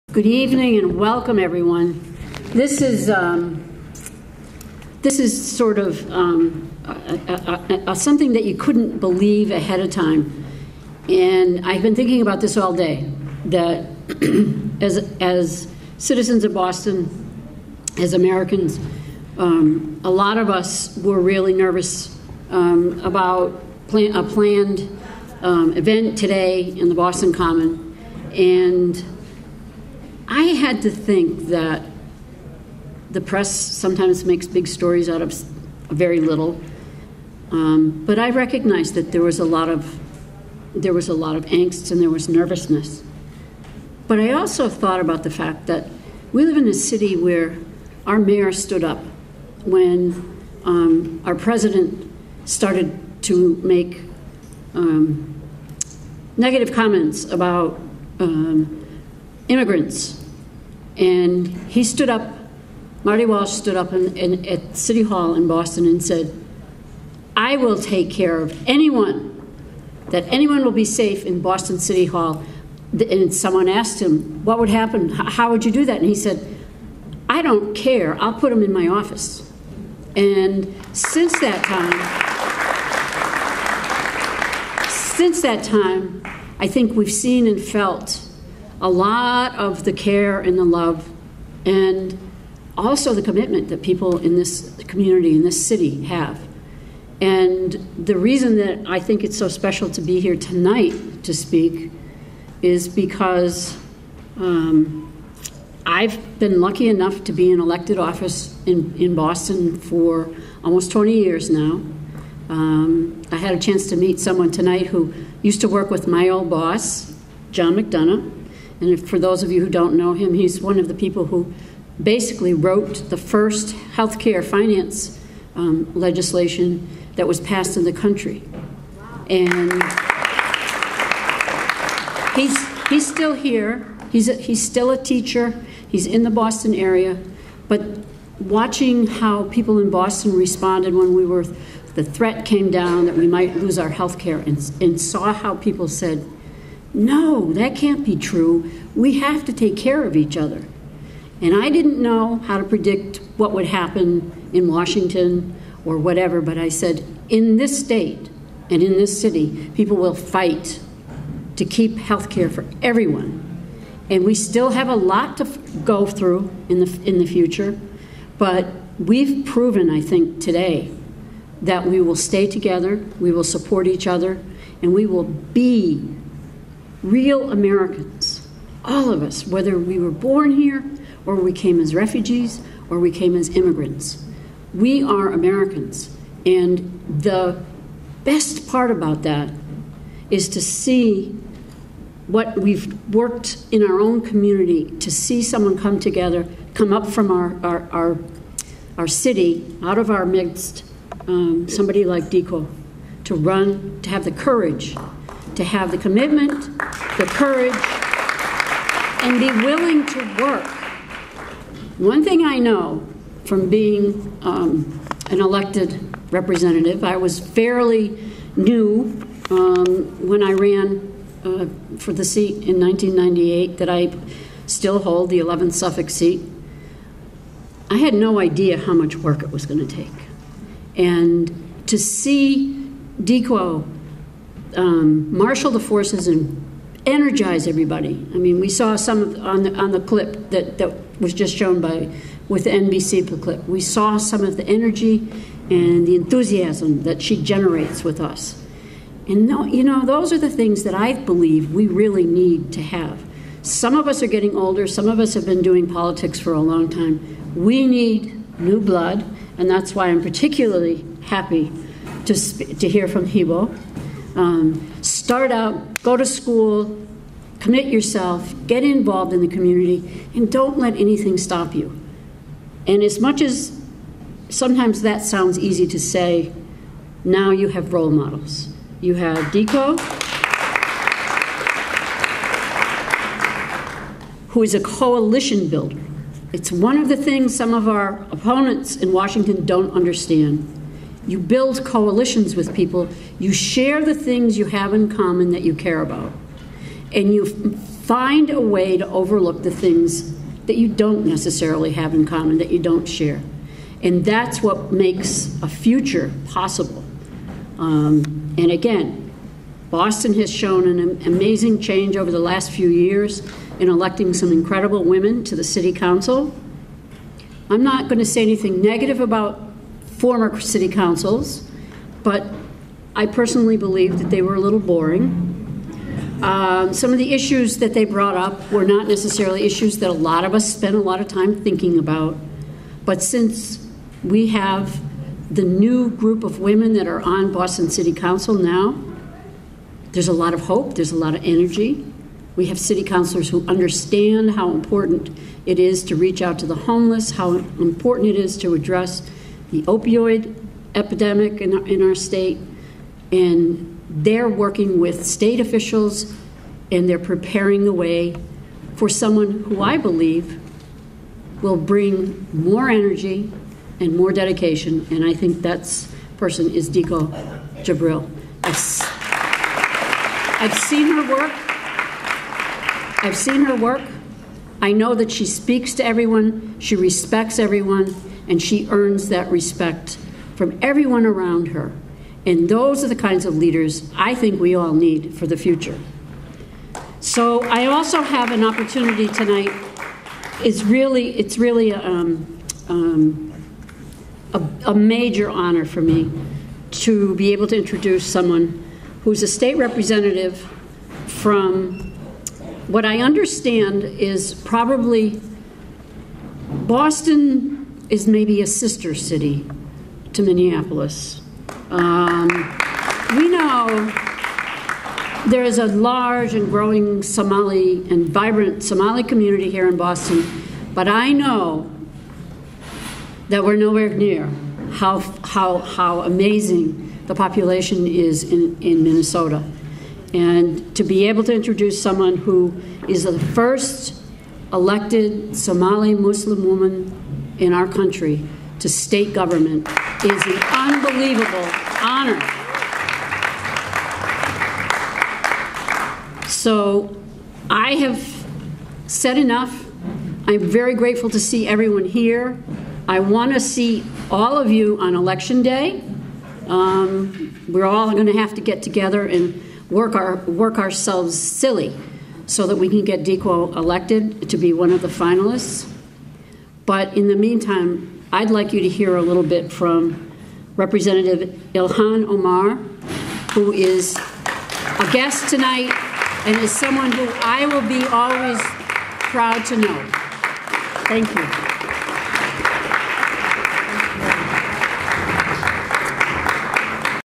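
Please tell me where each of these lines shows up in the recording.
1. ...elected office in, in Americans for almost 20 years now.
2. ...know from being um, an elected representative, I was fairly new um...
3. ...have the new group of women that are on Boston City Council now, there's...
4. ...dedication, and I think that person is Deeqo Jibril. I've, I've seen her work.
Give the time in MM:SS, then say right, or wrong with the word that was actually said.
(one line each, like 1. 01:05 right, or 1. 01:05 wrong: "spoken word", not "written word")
1. 01:47 wrong: "Boston", not "Americans"
2. 03:32 right
3. 05:34 right
4. 06:04 right.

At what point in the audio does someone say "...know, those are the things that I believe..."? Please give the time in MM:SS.
04:09.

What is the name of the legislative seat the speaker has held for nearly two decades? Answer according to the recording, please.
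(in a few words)
11th Suffolk.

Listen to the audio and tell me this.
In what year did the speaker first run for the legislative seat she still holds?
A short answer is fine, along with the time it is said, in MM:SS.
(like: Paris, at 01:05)
1998, at 03:42.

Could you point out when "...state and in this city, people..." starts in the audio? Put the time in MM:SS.
02:37.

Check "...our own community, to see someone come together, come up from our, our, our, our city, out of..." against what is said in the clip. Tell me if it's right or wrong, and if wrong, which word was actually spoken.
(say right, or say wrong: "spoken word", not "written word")
right.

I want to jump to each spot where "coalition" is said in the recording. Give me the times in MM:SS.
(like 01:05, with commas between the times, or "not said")
04:44, 04:51.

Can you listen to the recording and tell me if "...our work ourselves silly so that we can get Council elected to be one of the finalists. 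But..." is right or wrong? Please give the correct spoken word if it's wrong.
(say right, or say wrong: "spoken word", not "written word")
wrong: "Deeqo", not "Council".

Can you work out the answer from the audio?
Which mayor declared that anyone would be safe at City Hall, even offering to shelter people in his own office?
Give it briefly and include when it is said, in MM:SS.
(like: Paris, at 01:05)
Marty Walsh, at 01:03.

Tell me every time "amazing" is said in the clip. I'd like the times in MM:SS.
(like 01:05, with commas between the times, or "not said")
05:11, 07:06.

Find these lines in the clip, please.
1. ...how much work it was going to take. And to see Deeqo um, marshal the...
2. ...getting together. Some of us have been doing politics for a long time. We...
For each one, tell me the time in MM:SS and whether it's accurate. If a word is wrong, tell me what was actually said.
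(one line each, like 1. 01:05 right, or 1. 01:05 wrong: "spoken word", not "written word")
1. 03:48 right
2. 04:14 wrong: "older", not "together".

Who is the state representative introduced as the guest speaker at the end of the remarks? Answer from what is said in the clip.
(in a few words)
Ilhan Omar.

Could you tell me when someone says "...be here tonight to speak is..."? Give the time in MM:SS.
01:40.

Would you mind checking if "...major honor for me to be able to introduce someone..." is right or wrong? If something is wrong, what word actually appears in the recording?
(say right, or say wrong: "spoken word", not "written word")
right.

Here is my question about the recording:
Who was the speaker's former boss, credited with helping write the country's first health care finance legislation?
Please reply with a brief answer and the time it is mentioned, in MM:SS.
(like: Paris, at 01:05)
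John McDonough, at 01:57.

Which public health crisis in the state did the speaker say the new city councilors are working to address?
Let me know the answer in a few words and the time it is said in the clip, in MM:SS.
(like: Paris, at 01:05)
opioid epidemic, at 05:49.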